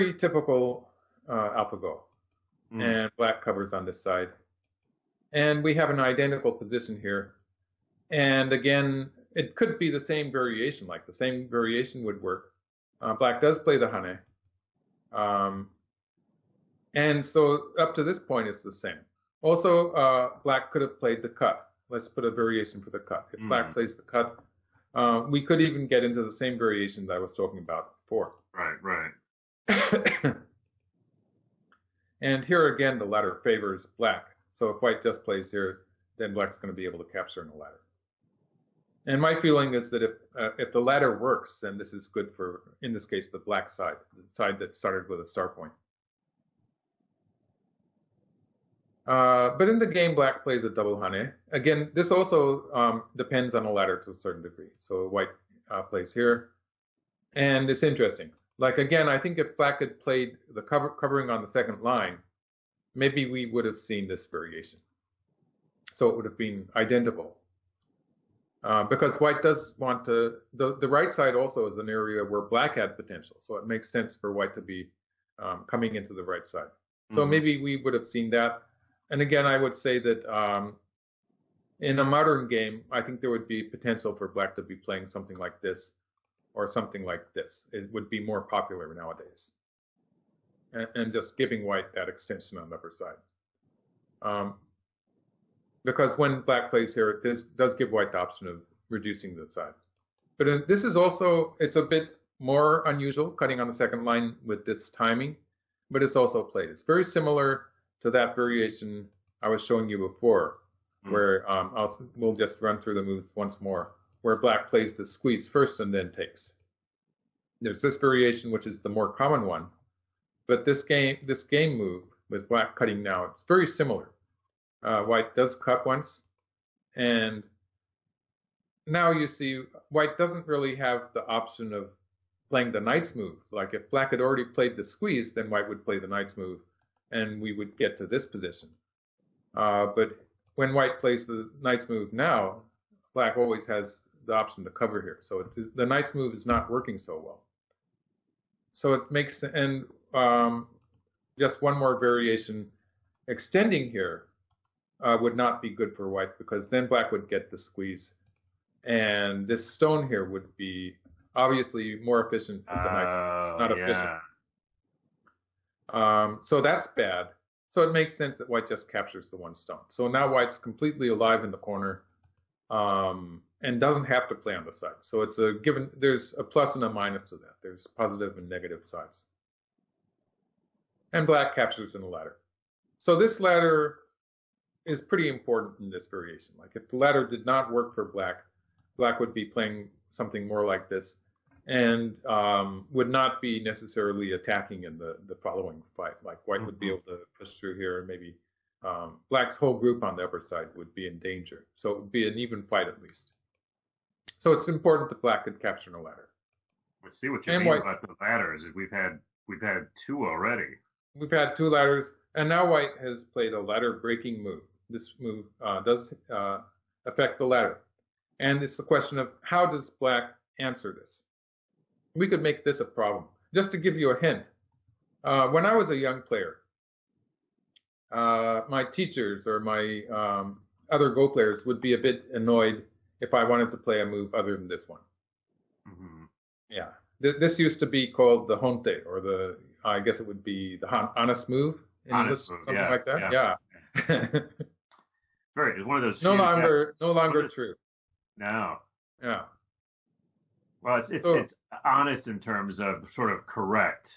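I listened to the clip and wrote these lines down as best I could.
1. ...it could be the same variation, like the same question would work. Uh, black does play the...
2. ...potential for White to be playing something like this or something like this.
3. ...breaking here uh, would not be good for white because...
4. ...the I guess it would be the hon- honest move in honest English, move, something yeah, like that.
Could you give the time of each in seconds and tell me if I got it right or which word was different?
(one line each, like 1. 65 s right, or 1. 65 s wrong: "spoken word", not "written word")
1. 9 s wrong: "variation", not "question"
2. 83 s wrong: "Black", not "White"
3. 153 s wrong: "extending", not "breaking"
4. 239 s right.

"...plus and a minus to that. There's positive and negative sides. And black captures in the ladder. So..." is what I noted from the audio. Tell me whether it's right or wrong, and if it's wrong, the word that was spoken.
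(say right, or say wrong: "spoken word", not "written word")
right.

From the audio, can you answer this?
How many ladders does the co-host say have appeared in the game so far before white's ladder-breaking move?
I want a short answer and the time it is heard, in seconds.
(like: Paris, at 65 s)
2, at 211 s.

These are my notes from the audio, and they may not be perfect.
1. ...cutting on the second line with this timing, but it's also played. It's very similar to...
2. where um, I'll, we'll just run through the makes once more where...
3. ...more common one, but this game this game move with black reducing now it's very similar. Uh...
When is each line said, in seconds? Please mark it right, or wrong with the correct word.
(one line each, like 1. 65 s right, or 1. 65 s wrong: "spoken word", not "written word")
1. 103 s right
2. 111 s wrong: "moves", not "makes"
3. 118 s wrong: "cutting", not "reducing".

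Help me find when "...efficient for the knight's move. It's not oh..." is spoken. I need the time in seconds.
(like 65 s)
162 s.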